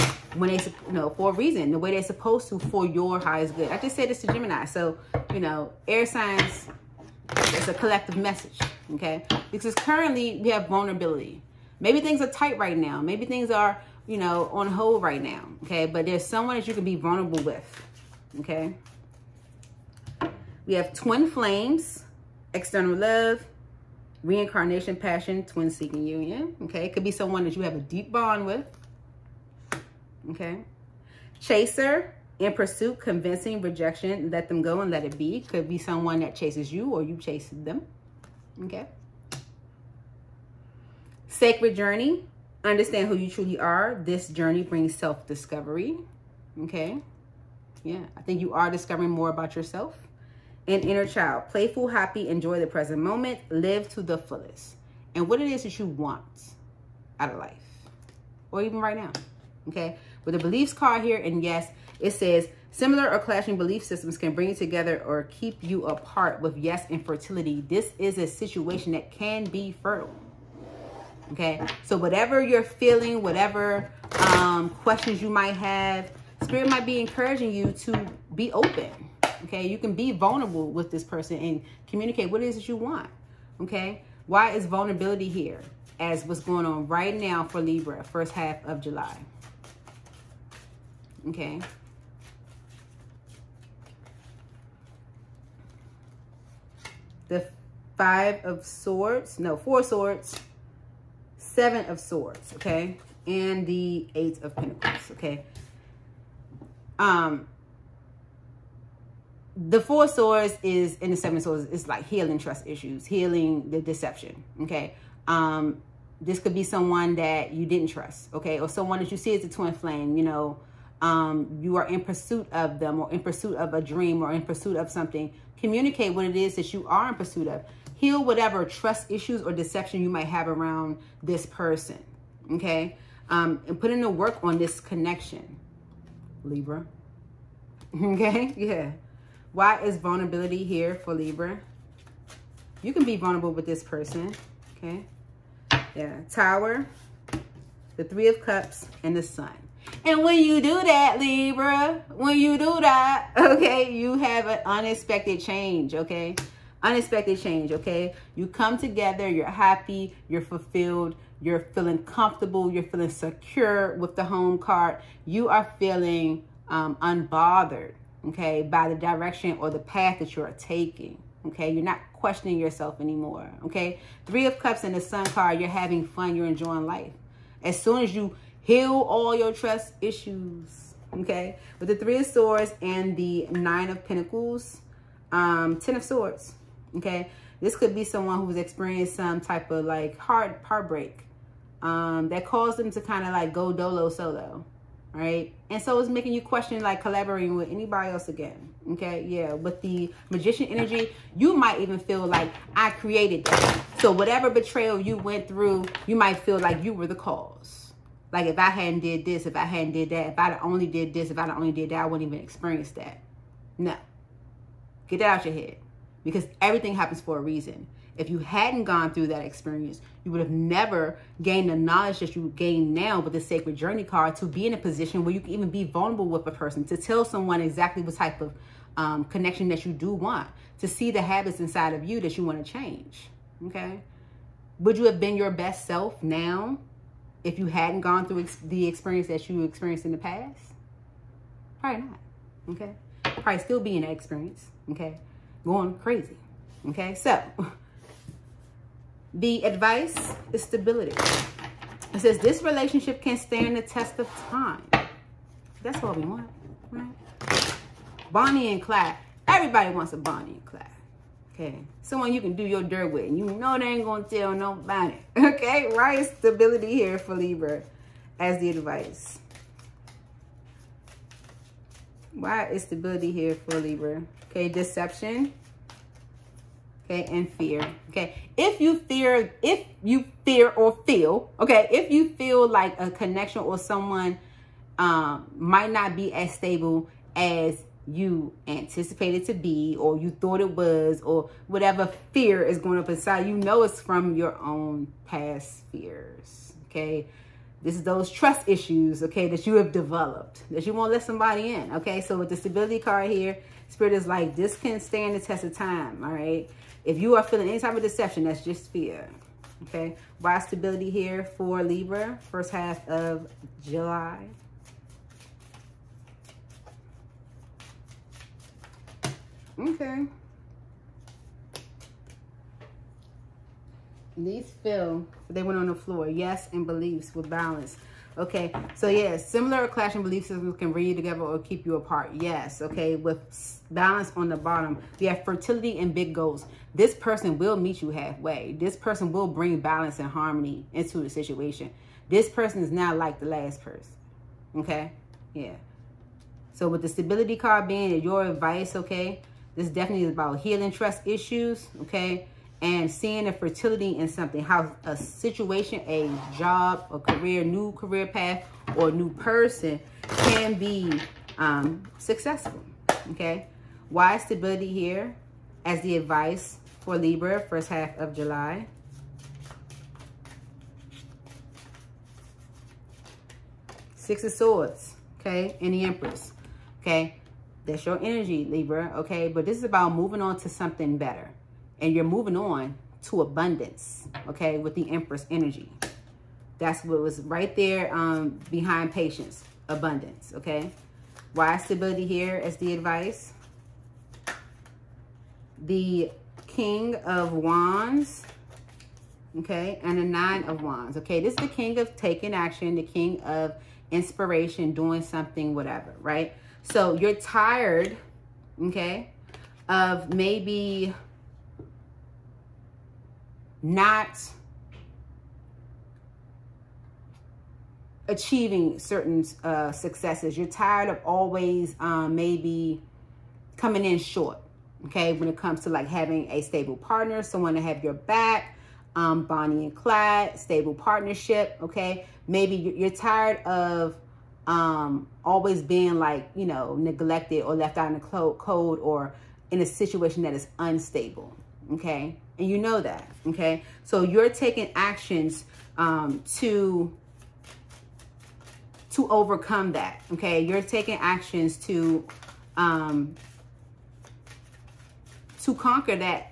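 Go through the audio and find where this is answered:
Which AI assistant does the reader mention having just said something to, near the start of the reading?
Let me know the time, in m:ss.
0:04.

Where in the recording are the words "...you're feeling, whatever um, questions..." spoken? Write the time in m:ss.
1:12.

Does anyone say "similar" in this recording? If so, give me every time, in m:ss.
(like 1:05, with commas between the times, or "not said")
1:02, 5:29.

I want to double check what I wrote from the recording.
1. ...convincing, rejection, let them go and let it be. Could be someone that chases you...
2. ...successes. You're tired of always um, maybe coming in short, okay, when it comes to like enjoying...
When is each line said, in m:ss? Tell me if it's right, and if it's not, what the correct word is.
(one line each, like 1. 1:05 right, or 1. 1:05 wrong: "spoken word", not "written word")
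1. 0:32 right
2. 6:59 wrong: "having", not "enjoying".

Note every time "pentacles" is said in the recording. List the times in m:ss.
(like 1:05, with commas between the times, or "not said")
1:44, 3:04.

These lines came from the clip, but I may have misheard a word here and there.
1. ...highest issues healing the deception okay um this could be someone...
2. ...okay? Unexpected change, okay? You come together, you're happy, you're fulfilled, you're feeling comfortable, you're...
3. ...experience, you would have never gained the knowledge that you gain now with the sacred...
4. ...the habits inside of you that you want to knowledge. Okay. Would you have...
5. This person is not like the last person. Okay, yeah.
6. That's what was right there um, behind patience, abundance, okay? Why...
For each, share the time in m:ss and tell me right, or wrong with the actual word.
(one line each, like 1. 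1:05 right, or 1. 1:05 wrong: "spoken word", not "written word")
1. 1:52 wrong: "trust", not "highest"
2. 2:35 right
3. 3:39 right
4. 3:51 wrong: "change", not "knowledge"
5. 5:42 right
6. 6:26 right.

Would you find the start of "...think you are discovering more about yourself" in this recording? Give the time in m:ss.
0:48.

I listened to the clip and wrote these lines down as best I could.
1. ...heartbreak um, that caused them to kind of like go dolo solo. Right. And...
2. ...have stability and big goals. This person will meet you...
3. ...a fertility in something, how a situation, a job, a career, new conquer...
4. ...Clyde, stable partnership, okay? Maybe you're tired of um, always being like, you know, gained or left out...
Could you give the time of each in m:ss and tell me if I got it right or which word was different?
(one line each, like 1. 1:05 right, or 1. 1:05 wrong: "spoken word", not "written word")
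1. 3:10 right
2. 5:35 wrong: "fertility", not "stability"
3. 5:53 wrong: "career", not "conquer"
4. 7:09 wrong: "neglected", not "gained".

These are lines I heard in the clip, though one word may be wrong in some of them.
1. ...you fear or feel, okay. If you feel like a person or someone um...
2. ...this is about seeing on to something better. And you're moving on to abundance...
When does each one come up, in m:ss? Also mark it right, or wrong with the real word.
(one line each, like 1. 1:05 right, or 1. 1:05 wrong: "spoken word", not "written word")
1. 4:40 wrong: "connection", not "person"
2. 6:19 wrong: "moving", not "seeing".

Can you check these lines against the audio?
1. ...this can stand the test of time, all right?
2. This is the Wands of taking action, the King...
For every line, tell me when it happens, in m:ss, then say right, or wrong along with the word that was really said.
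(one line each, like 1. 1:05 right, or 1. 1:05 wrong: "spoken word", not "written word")
1. 5:04 right
2. 6:41 wrong: "King", not "Wands".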